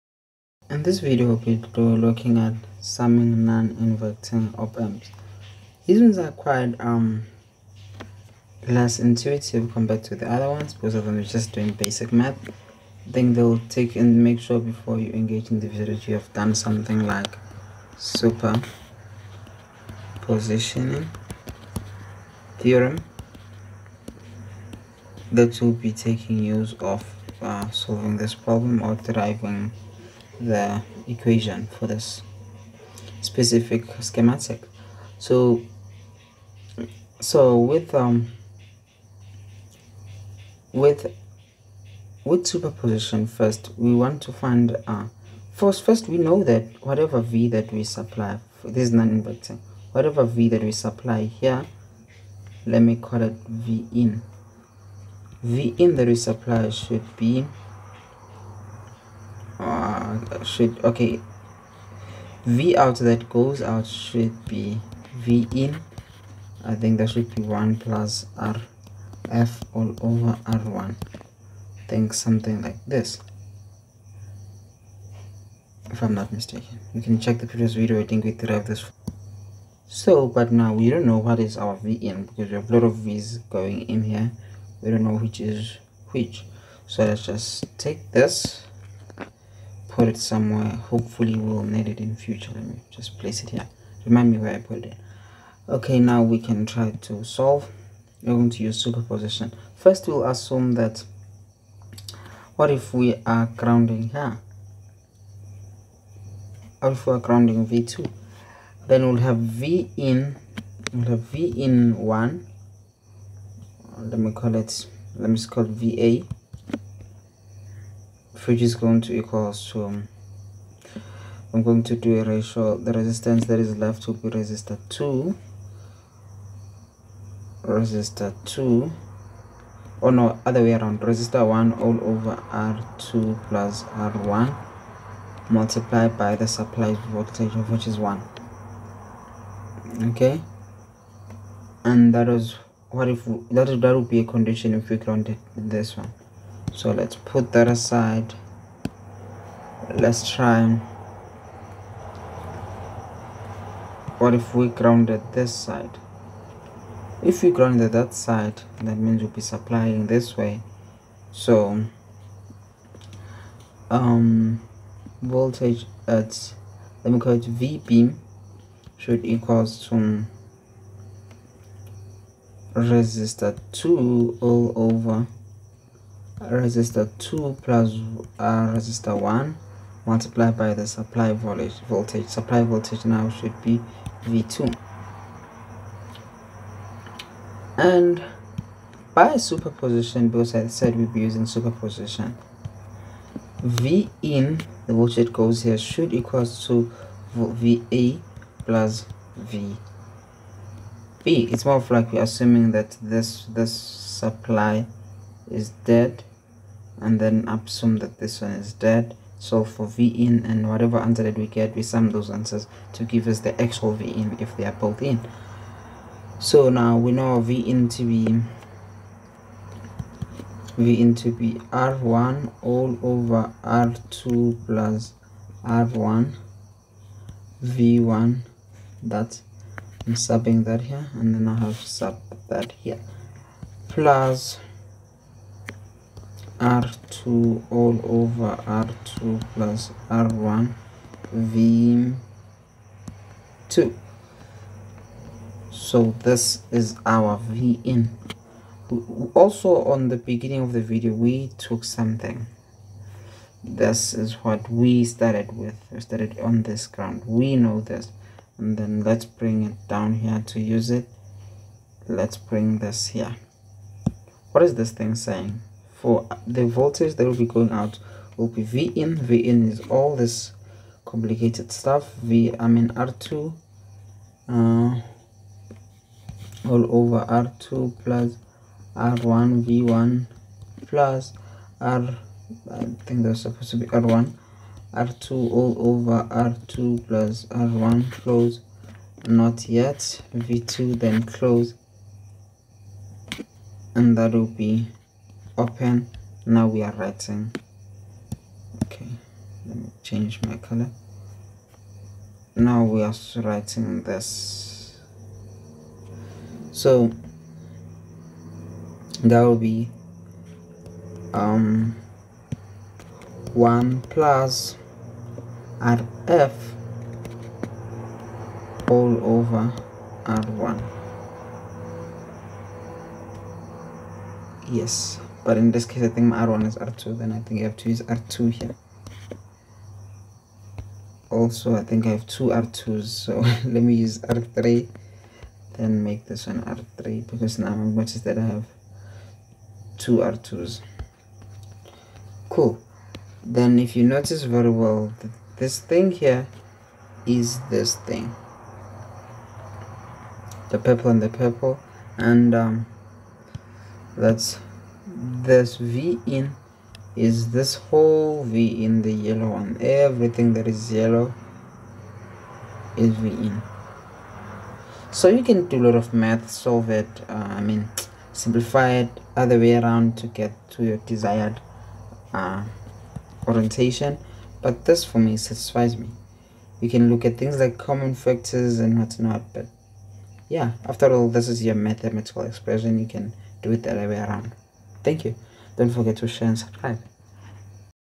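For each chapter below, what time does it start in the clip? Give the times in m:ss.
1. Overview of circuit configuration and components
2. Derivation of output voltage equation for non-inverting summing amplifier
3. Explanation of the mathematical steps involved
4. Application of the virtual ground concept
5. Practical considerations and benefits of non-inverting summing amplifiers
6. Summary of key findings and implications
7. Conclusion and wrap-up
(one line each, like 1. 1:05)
1. 0:30
2. 1:00
3. 2:30
4. 3:30
5. 4:00
6. 5:00
7. 5:30.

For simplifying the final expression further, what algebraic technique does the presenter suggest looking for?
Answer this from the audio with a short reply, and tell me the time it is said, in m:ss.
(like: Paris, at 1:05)
Common factors, at 6:17.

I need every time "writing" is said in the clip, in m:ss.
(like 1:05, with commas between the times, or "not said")
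4:56, 5:03.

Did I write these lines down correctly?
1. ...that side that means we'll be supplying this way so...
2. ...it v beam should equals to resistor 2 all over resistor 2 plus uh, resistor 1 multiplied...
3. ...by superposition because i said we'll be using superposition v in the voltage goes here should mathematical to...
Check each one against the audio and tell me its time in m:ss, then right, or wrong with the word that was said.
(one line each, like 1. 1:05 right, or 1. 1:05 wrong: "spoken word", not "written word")
1. 2:37 right
2. 2:47 right
3. 3:09 wrong: "equal", not "mathematical".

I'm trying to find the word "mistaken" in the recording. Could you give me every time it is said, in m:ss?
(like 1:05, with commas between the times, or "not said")
1:16.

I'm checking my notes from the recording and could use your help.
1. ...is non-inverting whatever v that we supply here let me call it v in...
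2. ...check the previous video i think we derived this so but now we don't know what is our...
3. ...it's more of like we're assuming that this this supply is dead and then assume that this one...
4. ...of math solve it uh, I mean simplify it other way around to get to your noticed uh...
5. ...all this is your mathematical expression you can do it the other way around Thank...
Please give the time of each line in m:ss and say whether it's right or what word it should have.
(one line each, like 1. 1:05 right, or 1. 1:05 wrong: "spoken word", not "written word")
1. 0:48 right
2. 1:17 right
3. 3:21 right
4. 6:05 wrong: "desired", not "noticed"
5. 6:21 right.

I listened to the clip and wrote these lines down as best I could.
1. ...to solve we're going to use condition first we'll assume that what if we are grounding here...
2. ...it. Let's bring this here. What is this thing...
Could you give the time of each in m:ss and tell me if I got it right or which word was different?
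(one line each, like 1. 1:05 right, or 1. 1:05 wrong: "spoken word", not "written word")
1. 1:37 wrong: "superposition", not "condition"
2. 4:20 right.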